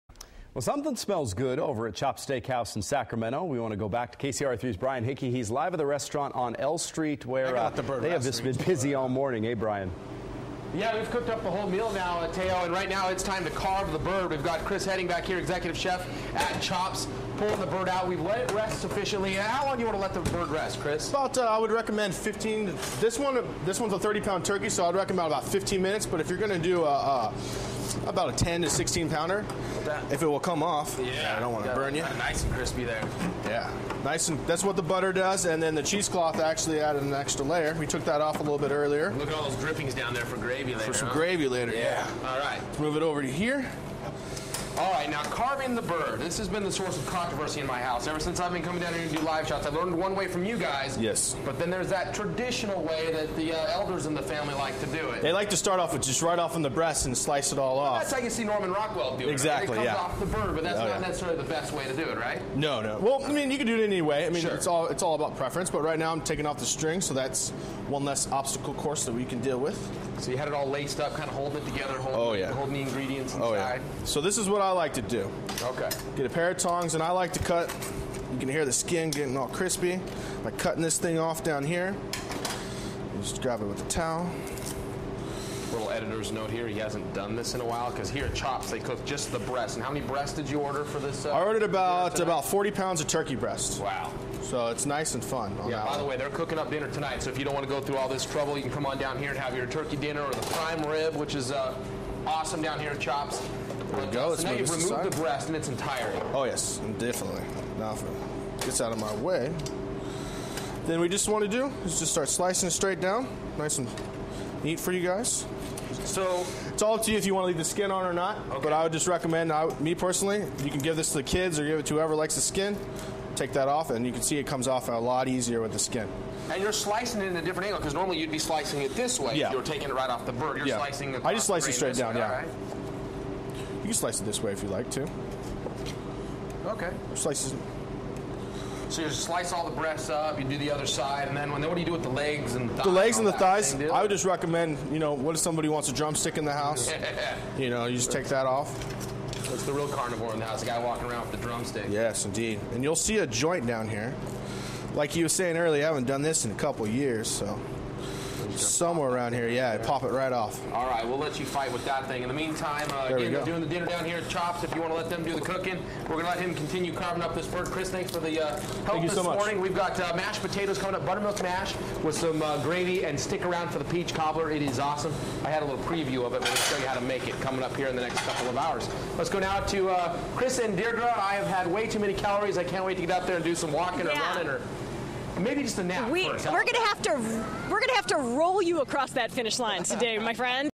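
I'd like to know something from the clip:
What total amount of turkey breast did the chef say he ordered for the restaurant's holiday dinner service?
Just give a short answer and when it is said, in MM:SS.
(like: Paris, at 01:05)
40 pounds, at 01:32.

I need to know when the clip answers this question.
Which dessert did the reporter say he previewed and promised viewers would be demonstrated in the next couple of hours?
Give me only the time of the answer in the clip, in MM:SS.
02:53.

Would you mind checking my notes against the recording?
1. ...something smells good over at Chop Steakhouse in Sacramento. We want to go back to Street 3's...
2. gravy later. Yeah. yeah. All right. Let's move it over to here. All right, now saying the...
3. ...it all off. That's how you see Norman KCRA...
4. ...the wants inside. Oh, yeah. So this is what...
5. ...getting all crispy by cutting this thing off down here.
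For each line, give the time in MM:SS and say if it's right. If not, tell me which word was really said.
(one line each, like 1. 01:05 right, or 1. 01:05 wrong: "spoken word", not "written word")
1. 00:00 wrong: "KCRA", not "Street"
2. 00:41 wrong: "carving", not "saying"
3. 00:57 wrong: "Rockwell", not "KCRA"
4. 01:12 wrong: "ingredients", not "wants"
5. 01:19 right.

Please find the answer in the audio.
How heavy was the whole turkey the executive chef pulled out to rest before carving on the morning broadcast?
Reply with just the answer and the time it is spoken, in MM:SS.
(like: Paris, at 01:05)
30 pounds, at 00:23.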